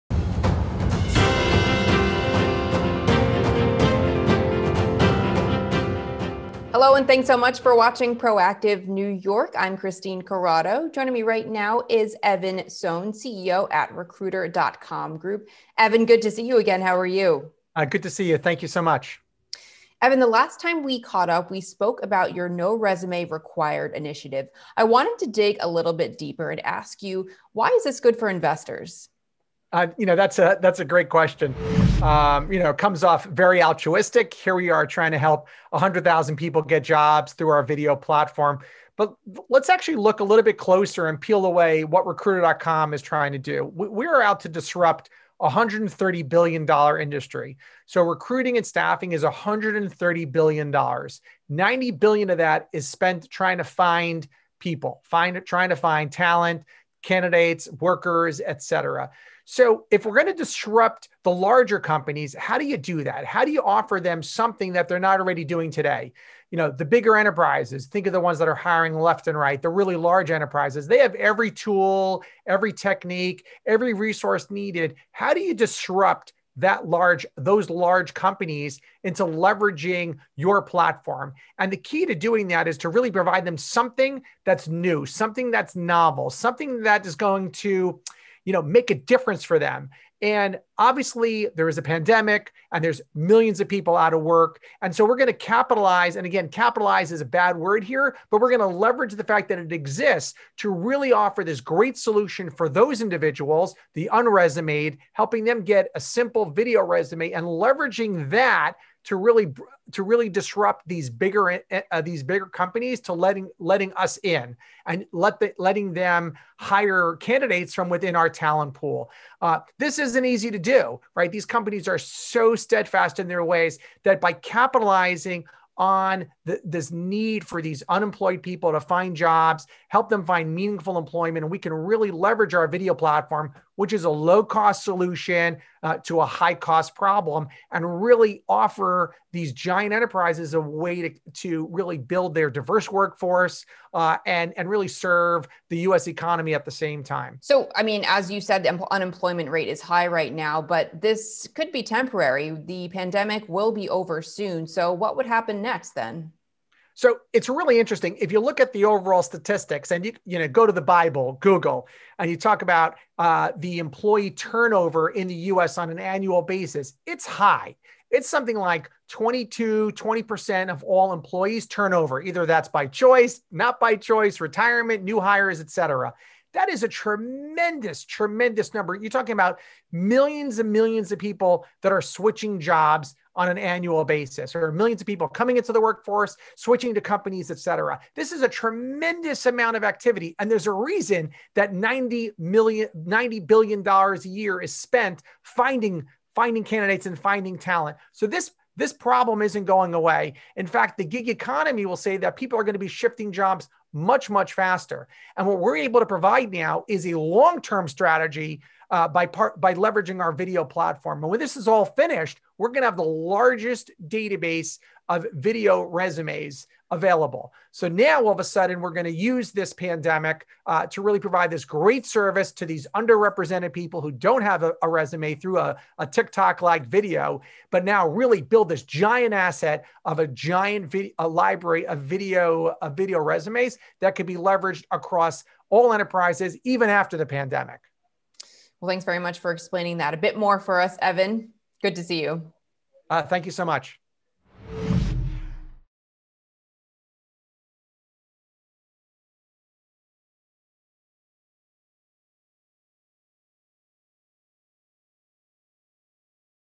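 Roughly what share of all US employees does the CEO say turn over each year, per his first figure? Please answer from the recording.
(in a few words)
22%.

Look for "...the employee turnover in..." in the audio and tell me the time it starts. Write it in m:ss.
2:43.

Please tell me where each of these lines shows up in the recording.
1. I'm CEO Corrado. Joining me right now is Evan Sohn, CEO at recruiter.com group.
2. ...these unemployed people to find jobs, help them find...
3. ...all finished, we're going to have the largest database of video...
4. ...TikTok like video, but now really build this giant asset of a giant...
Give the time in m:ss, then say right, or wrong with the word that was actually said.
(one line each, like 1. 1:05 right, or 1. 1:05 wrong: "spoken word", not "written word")
1. 0:09 wrong: "Christine", not "CEO"
2. 2:07 right
3. 3:31 right
4. 3:46 right.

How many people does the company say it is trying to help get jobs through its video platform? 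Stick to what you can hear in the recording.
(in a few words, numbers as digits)
100,000.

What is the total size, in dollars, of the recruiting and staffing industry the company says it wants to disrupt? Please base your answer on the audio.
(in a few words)
$130 billion.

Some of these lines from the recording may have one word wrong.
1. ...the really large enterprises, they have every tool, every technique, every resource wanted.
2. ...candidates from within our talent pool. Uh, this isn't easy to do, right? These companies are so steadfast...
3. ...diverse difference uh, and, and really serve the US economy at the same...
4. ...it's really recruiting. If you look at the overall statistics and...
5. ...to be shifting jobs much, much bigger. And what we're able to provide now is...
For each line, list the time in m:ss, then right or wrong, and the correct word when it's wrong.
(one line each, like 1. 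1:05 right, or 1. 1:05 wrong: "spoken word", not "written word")
1. 1:09 wrong: "needed", not "wanted"
2. 1:57 right
3. 2:22 wrong: "workforce", not "difference"
4. 2:37 wrong: "interesting", not "recruiting"
5. 3:22 wrong: "faster", not "bigger".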